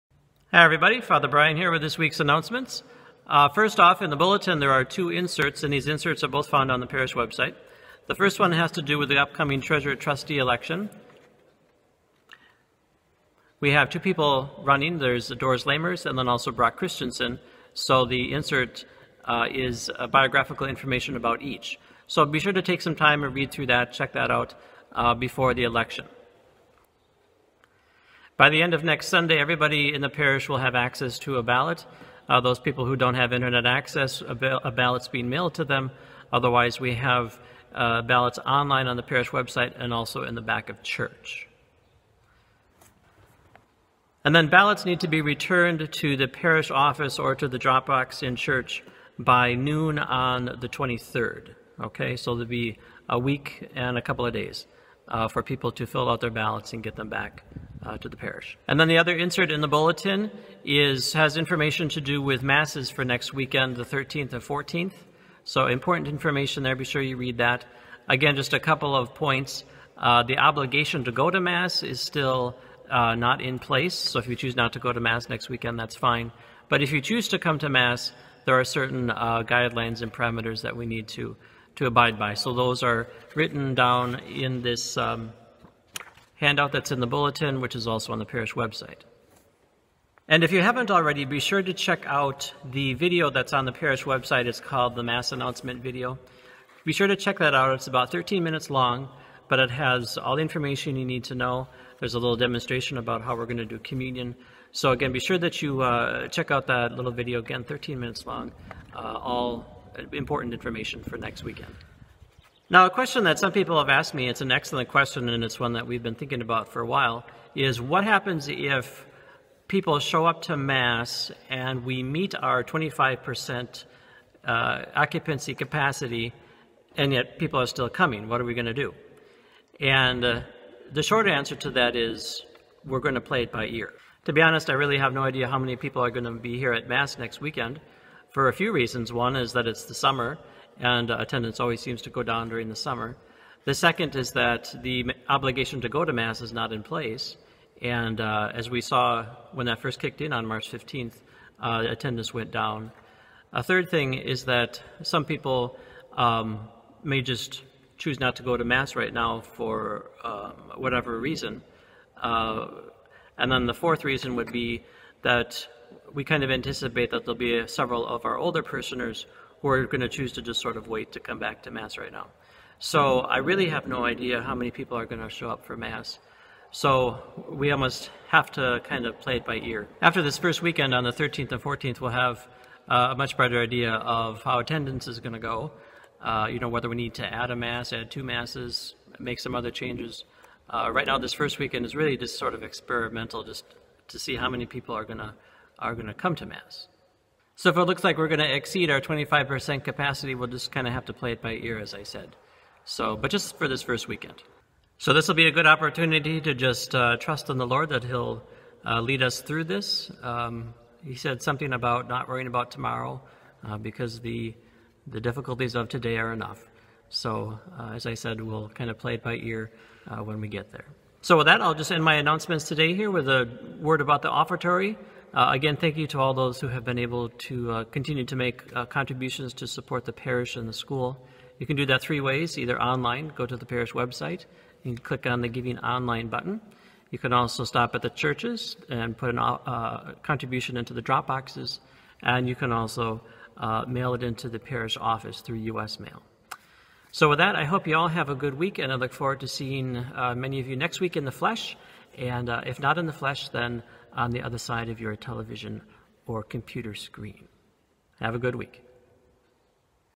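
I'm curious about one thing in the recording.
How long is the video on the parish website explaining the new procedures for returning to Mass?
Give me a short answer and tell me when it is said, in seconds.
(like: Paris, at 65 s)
13 minutes, at 97 s.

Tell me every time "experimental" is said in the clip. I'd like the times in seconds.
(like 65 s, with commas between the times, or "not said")
192 s.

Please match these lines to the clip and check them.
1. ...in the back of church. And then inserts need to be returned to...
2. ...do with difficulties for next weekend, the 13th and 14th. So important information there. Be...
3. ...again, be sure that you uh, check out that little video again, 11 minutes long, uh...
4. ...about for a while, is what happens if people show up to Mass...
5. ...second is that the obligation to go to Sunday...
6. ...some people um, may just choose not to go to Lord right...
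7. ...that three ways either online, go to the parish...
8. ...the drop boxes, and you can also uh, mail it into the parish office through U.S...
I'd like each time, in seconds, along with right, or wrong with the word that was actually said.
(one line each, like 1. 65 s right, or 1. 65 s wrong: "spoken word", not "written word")
1. 40 s wrong: "ballots", not "inserts"
2. 62 s wrong: "masses", not "difficulties"
3. 104 s wrong: "13", not "11"
4. 116 s right
5. 143 s wrong: "Mass", not "Sunday"
6. 155 s wrong: "Mass", not "Lord"
7. 231 s right
8. 240 s right.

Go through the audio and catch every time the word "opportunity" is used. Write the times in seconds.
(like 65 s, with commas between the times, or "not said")
205 s.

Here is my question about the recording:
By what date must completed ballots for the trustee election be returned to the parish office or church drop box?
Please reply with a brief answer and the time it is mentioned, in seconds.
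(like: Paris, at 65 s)
the 23rd, at 50 s.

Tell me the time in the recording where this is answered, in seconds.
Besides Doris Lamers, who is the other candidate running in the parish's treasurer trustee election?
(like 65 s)
16 s.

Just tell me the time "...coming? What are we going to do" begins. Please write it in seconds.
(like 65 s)
127 s.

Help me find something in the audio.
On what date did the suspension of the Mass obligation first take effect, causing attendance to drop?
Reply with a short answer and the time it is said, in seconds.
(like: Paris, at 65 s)
March 15, at 150 s.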